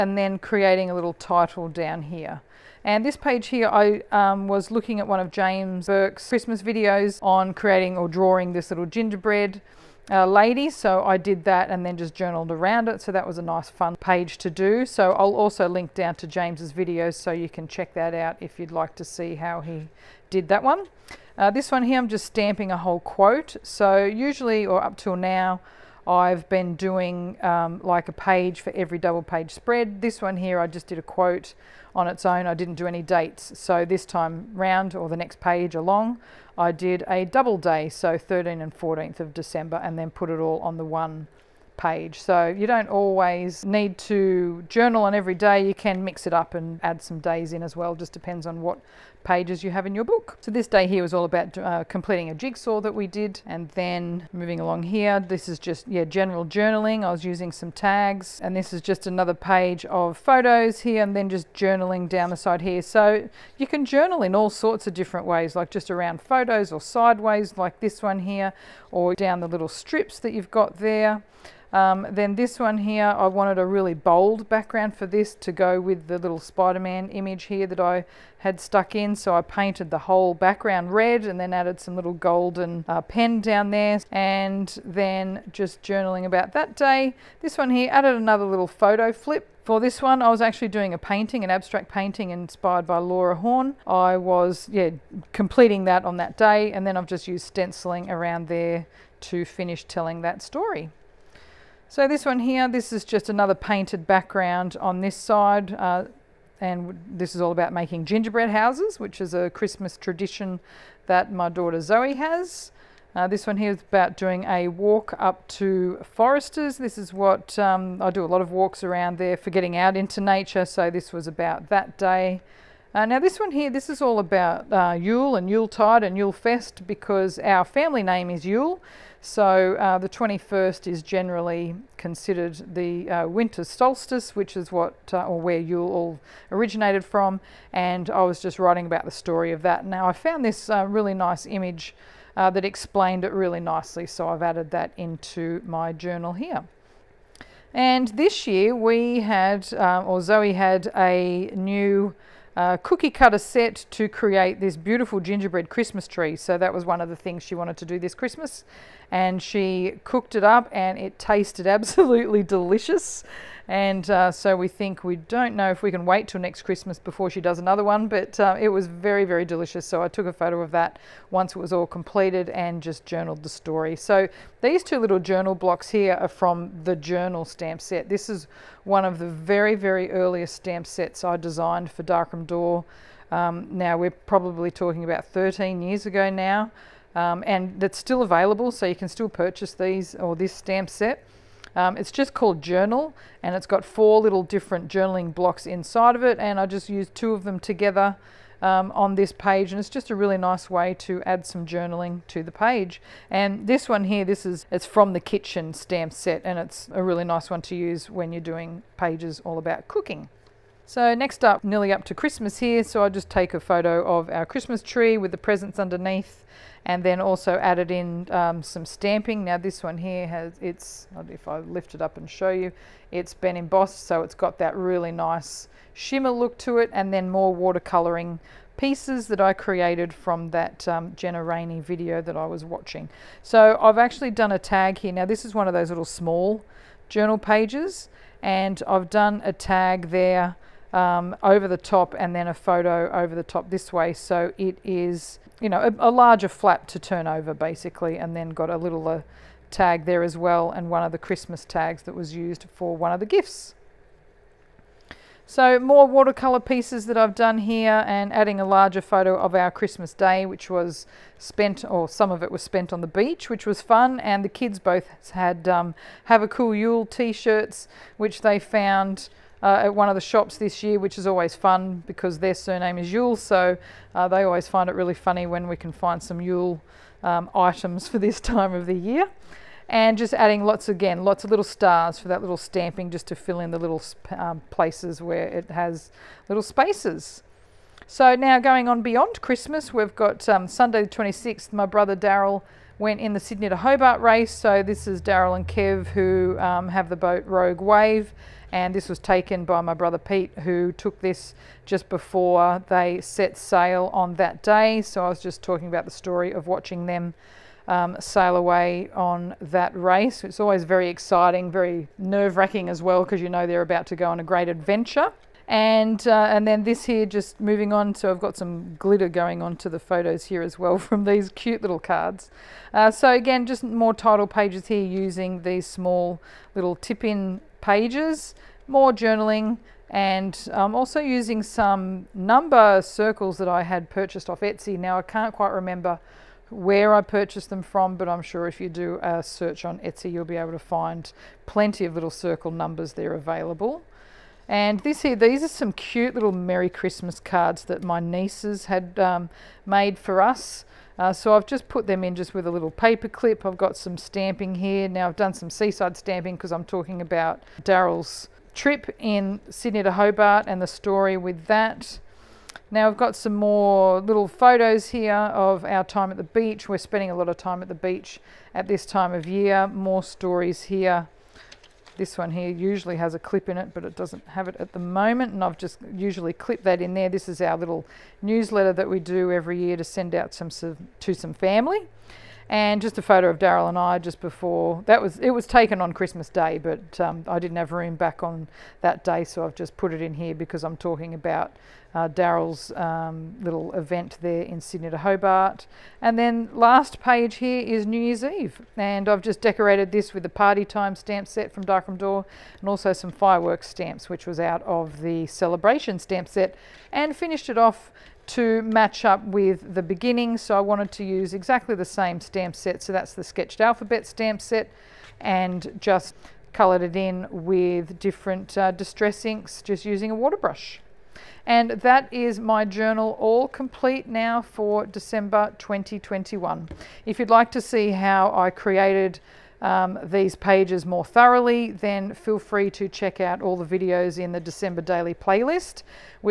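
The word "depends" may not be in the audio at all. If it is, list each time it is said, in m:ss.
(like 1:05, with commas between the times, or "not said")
0:48.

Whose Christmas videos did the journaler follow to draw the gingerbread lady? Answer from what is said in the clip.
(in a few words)
James Burke.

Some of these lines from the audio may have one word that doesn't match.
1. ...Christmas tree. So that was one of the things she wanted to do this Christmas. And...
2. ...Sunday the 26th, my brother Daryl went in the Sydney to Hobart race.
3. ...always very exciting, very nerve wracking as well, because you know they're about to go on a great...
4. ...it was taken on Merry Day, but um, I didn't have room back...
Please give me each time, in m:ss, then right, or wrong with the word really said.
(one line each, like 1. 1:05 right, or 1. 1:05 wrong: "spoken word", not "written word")
1. 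2:35 right
2. 4:50 right
3. 5:10 right
4. 6:25 wrong: "Christmas", not "Merry".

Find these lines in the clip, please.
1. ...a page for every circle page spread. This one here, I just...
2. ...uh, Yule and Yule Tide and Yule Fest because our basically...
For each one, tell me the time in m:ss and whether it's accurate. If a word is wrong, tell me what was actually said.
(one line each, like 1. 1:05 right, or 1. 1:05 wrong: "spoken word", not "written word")
1. 0:28 wrong: "double", not "circle"
2. 2:04 wrong: "family", not "basically".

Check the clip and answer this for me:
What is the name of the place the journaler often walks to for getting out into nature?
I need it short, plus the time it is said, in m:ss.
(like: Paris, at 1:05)
Foresters, at 1:56.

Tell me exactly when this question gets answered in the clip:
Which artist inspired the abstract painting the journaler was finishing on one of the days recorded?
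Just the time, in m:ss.
1:32.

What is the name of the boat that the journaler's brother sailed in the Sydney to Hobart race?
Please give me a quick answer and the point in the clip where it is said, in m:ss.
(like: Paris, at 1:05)
Rogue Wave, at 4:57.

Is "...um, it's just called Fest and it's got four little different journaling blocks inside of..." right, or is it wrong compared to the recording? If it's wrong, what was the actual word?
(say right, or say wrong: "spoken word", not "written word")
wrong: "Journal", not "Fest".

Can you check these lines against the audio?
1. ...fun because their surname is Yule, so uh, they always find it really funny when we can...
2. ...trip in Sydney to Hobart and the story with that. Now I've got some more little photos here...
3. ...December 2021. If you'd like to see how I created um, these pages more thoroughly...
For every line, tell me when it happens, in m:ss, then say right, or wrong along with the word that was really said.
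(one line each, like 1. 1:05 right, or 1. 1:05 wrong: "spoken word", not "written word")
1. 4:31 right
2. 5:58 right
3. 7:05 right.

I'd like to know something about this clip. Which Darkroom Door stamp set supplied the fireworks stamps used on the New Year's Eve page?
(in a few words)
celebration.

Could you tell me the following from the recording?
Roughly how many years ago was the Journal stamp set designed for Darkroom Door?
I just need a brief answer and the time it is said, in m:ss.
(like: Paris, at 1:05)
13, at 3:05.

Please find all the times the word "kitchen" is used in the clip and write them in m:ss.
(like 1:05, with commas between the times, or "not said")
3:25.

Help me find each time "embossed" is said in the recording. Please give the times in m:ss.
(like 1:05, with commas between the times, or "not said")
3:43.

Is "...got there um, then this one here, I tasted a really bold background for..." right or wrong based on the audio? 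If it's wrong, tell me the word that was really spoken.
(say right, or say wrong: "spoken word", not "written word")
wrong: "wanted", not "tasted".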